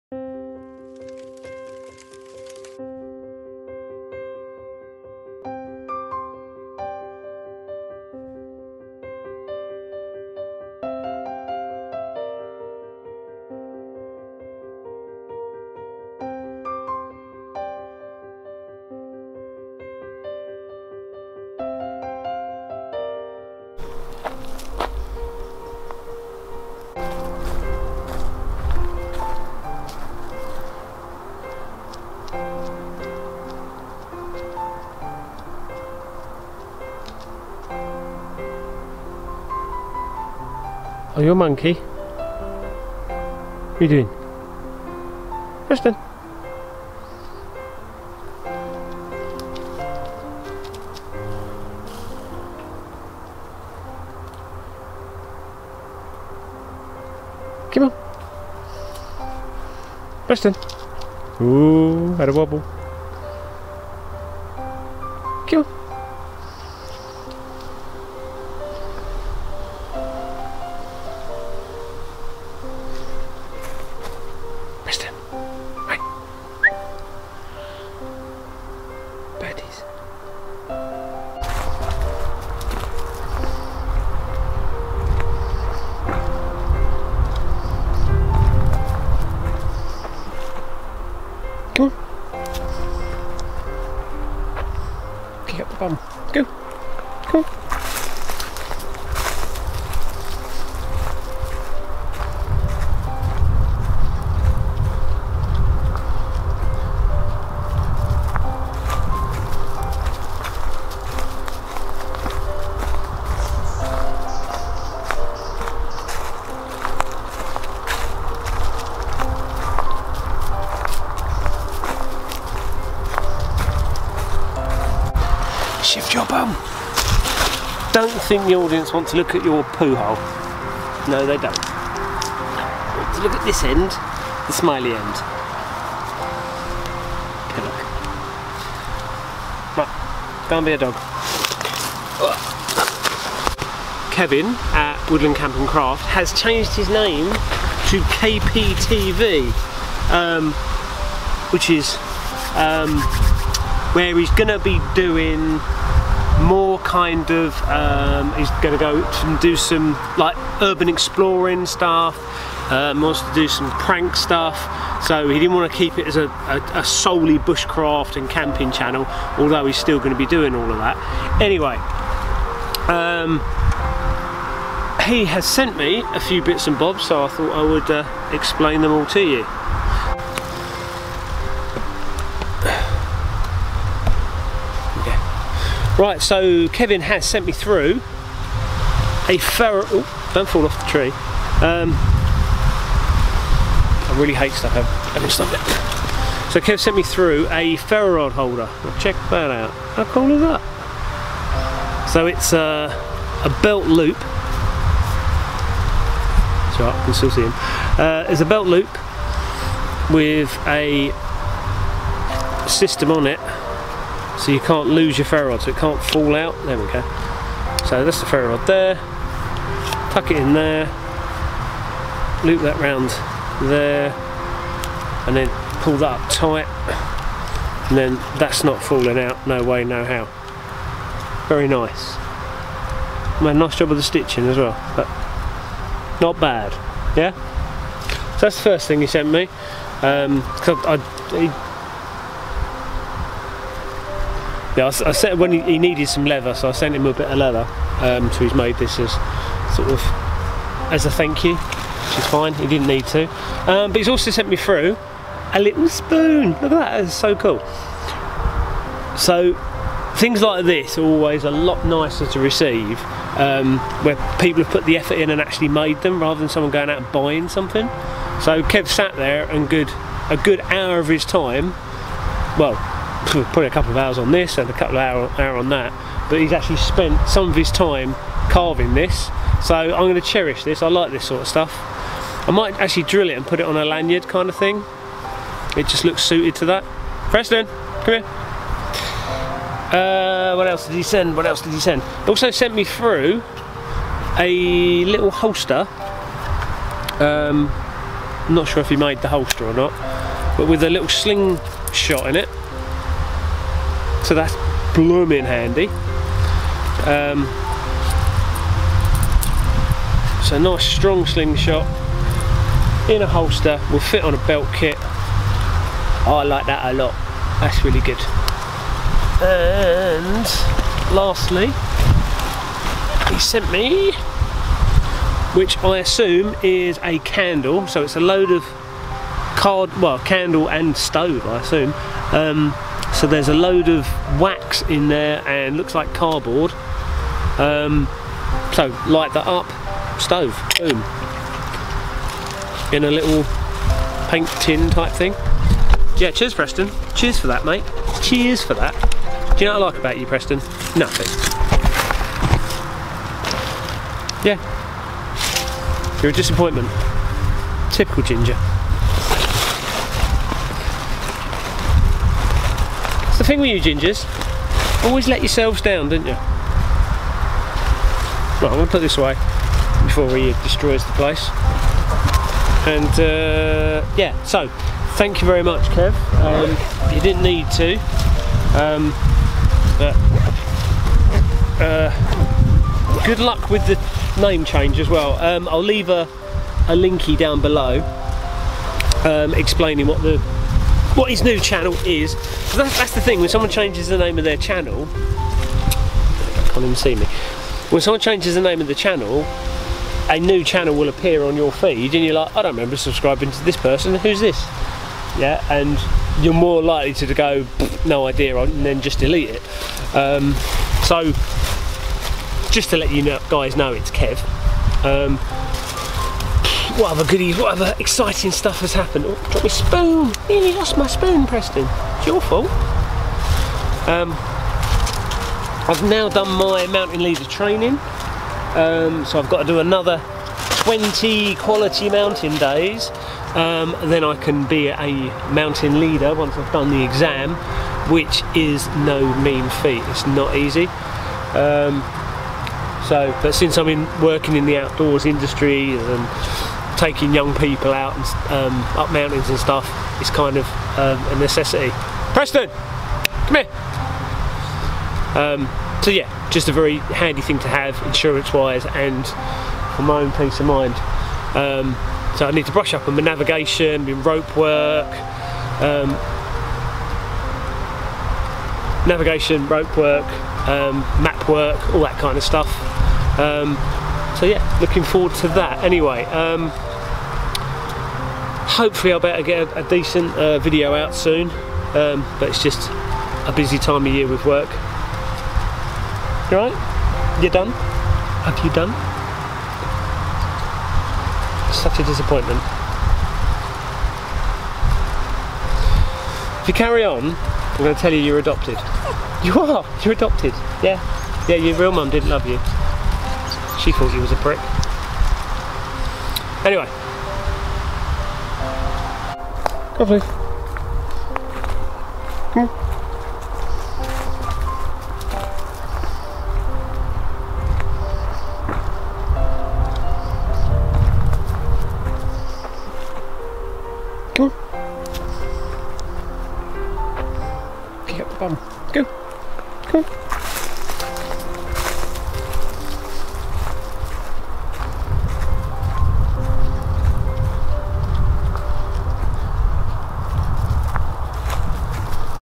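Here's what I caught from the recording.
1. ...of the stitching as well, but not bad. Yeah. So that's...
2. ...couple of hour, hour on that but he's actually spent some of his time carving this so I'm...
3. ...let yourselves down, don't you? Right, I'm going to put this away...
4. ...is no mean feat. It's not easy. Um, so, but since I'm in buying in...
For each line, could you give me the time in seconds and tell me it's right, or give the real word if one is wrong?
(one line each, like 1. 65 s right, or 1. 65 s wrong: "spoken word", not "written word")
1. 233 s right
2. 274 s right
3. 365 s right
4. 438 s wrong: "working", not "buying".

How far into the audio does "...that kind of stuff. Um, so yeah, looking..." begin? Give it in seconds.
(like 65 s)
472 s.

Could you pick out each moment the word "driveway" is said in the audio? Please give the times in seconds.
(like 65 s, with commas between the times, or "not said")
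not said.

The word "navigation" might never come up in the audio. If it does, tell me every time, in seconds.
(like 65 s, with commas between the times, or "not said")
463 s, 469 s.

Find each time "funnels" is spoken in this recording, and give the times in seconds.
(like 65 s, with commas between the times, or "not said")
not said.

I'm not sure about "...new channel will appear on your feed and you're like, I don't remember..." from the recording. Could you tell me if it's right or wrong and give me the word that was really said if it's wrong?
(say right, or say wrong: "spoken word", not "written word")
right.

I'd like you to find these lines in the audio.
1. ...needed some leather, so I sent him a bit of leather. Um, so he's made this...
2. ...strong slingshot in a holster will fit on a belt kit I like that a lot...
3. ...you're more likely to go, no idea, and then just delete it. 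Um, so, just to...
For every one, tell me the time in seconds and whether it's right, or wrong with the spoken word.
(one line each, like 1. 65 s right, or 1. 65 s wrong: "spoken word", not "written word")
1. 245 s right
2. 310 s right
3. 406 s right.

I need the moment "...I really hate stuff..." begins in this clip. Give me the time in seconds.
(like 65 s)
194 s.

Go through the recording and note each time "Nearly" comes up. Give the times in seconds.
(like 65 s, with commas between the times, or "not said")
420 s.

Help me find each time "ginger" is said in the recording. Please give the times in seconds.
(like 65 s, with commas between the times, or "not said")
358 s, 363 s.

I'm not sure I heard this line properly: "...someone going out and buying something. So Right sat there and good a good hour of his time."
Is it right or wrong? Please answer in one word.
wrong.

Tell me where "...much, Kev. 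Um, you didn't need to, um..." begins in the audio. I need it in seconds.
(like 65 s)
375 s.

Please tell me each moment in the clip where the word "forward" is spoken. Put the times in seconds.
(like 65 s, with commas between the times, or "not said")
475 s.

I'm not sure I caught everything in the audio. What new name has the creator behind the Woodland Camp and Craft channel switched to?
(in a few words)
KPTV.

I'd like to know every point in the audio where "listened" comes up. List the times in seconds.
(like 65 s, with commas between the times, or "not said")
not said.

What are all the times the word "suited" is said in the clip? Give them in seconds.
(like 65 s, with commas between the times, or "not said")
286 s.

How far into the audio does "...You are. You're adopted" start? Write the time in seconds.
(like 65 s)
499 s.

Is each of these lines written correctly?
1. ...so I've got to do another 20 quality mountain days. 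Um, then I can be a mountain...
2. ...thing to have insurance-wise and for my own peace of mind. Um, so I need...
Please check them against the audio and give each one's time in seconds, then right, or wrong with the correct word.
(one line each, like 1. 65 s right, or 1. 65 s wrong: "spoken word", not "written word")
1. 429 s right
2. 457 s right.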